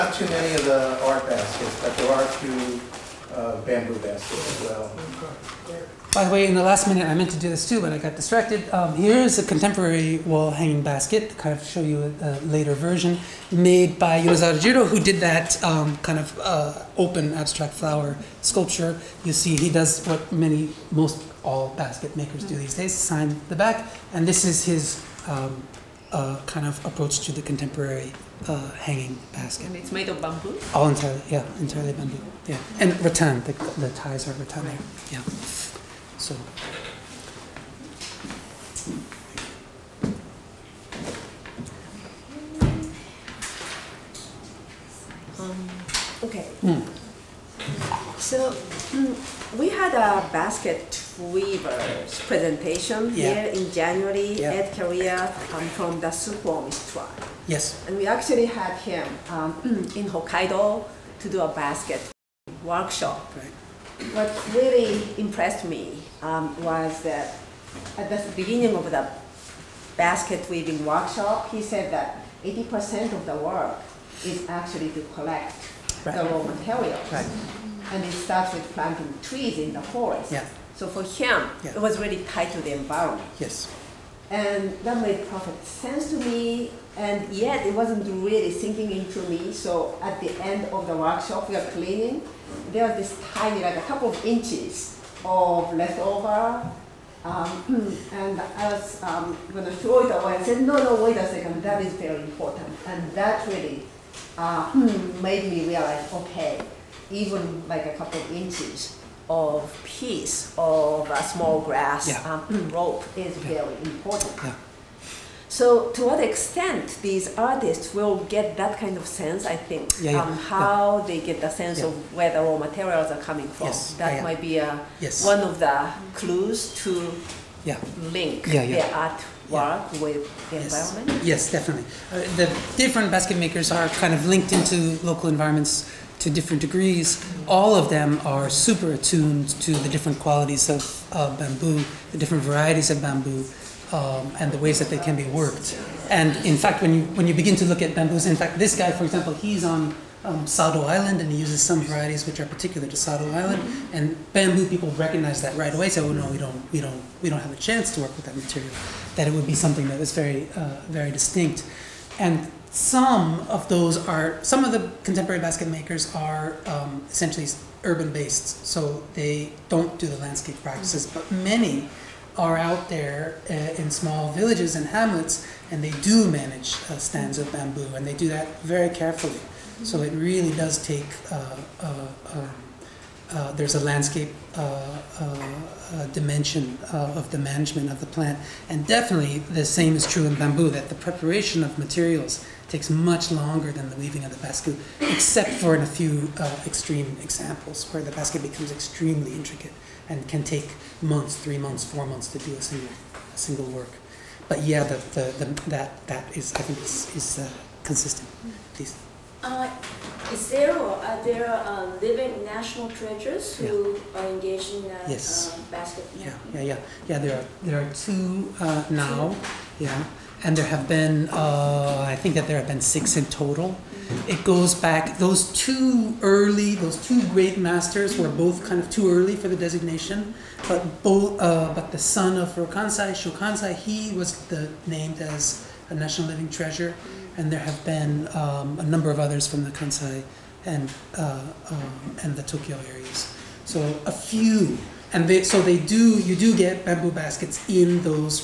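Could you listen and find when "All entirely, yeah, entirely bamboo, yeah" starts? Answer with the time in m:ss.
0:30.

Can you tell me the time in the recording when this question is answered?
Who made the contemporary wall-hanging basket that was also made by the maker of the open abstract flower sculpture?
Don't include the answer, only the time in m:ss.
0:14.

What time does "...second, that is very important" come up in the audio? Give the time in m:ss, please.
1:41.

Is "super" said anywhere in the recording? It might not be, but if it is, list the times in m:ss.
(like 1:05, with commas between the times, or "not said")
2:18.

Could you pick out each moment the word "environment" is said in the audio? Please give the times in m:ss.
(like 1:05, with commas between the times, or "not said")
1:22, 2:10, 2:15.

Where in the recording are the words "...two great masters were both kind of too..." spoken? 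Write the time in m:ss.
3:47.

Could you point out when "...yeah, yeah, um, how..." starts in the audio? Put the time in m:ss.
1:59.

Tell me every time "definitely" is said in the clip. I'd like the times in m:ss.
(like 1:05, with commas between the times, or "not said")
2:11, 3:08.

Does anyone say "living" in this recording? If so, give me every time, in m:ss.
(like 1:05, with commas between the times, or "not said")
3:32, 3:56.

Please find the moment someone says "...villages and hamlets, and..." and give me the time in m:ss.
2:54.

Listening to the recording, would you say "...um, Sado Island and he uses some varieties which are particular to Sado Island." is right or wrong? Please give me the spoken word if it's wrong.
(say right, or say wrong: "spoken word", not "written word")
right.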